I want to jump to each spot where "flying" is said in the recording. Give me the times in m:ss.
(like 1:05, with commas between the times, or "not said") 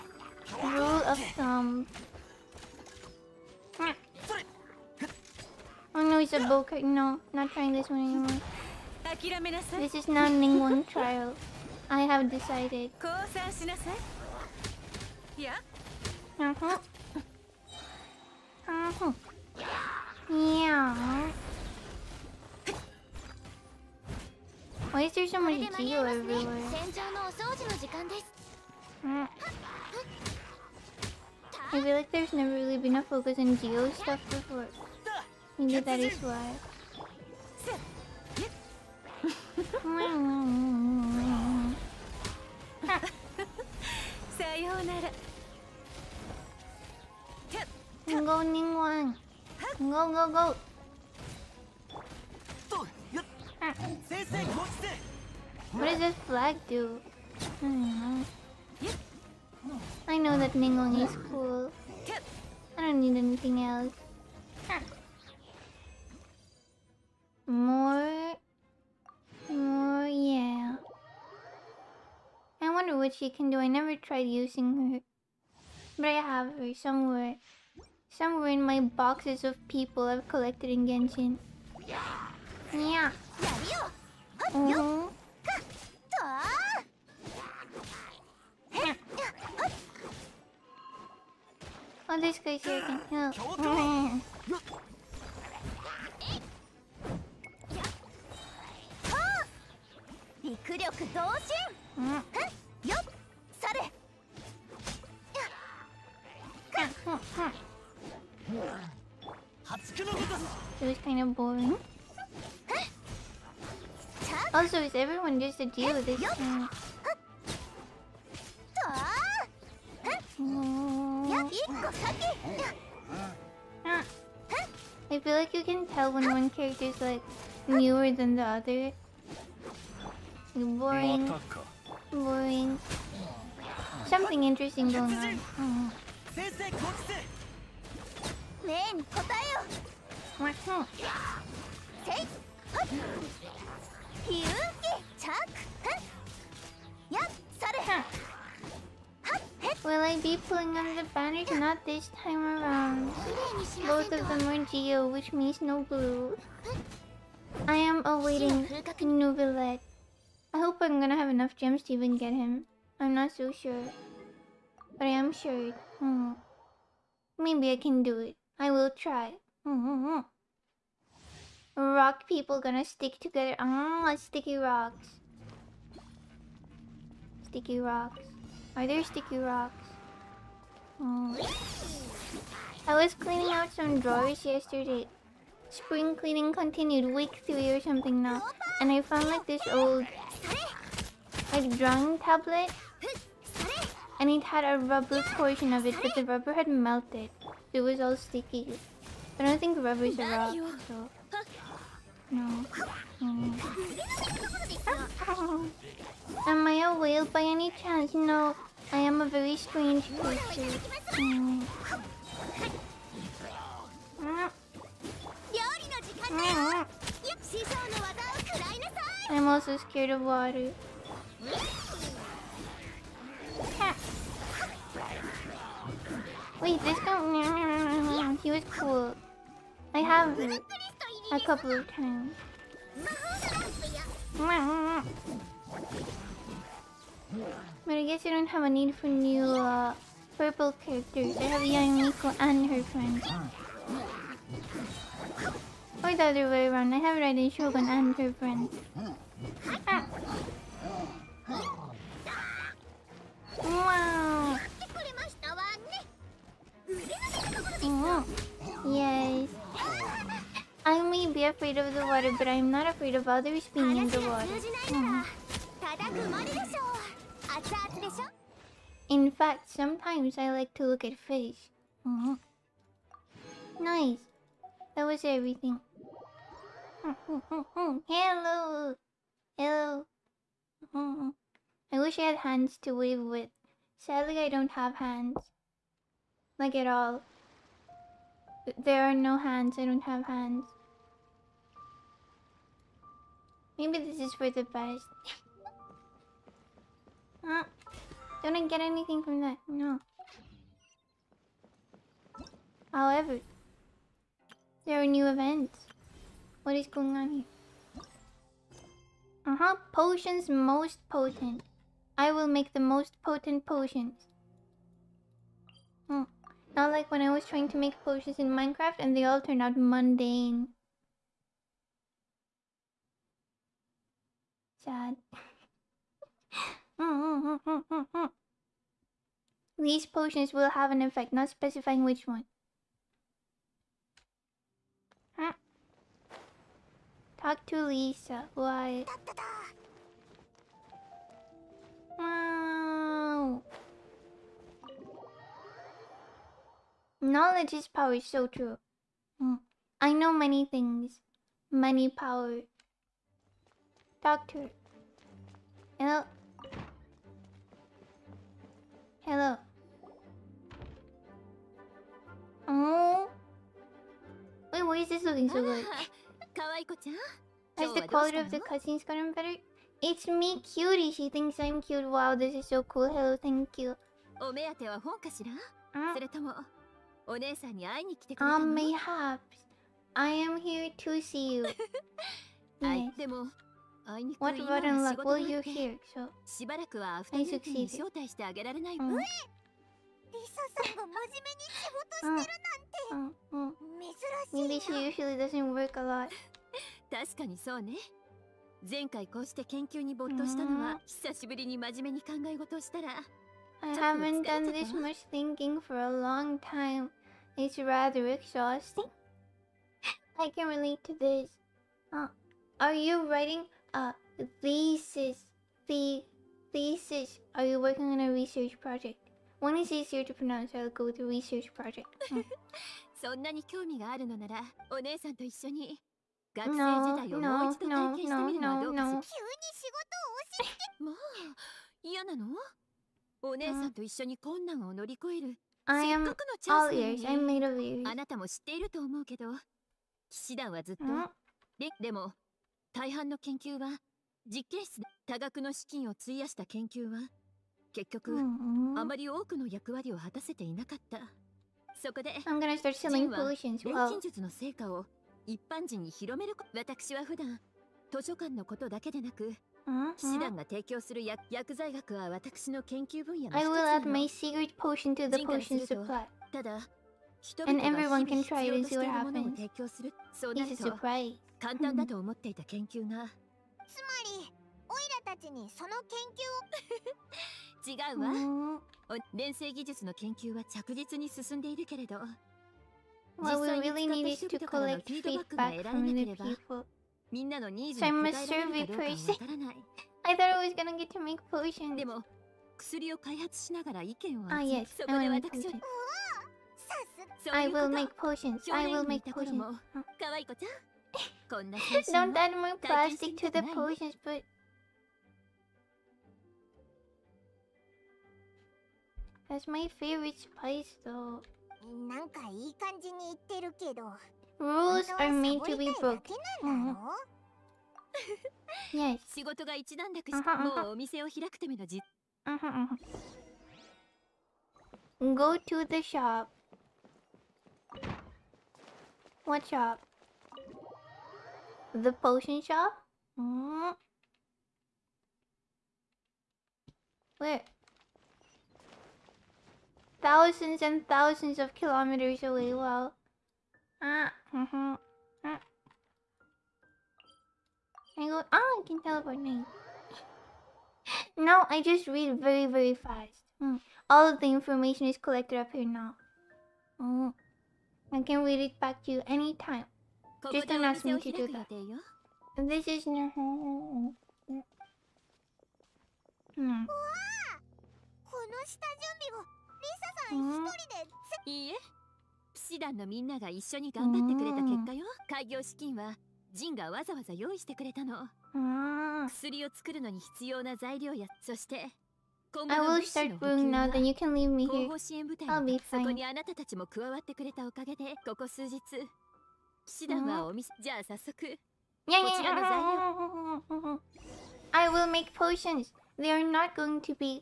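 not said.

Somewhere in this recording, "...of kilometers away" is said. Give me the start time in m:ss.
9:01.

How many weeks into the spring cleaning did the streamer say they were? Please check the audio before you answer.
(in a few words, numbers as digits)
3.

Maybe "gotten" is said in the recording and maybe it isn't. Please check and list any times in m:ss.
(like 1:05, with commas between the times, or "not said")
6:09.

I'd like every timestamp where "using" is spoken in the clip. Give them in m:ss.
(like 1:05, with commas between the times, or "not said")
1:14.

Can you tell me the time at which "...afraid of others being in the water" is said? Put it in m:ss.
4:22.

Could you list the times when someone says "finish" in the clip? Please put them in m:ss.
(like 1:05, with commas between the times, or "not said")
not said.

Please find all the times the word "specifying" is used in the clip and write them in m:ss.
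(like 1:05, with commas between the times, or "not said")
5:31.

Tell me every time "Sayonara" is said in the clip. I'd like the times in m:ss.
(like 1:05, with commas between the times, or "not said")
0:44.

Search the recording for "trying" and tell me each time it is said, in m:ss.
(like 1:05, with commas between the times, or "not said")
0:07, 5:17.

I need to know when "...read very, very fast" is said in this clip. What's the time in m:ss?
9:12.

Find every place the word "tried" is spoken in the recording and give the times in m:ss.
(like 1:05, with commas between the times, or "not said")
1:13.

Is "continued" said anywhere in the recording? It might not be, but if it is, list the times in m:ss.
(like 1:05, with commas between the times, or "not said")
3:06.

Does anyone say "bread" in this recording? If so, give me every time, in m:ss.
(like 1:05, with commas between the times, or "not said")
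not said.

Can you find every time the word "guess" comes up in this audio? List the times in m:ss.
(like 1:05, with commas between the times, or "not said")
3:58.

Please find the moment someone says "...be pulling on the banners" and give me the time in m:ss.
2:30.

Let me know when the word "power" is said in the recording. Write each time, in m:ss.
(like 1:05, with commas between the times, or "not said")
5:47, 5:52.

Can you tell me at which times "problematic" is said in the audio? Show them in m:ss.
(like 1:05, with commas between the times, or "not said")
not said.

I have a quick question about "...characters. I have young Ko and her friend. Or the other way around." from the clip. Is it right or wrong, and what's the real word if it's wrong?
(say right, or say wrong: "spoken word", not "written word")
right.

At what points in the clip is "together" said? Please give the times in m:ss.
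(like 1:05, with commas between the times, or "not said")
2:53.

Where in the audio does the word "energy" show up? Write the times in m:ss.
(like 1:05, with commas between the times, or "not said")
not said.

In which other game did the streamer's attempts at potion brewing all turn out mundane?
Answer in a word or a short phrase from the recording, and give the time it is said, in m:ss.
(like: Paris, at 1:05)
Minecraft, at 5:18.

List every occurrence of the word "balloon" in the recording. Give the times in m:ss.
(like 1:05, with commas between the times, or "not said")
not said.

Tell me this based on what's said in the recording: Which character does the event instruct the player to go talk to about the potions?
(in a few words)
Lisa.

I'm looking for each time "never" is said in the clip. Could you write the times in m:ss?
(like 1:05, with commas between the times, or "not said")
0:32, 1:13.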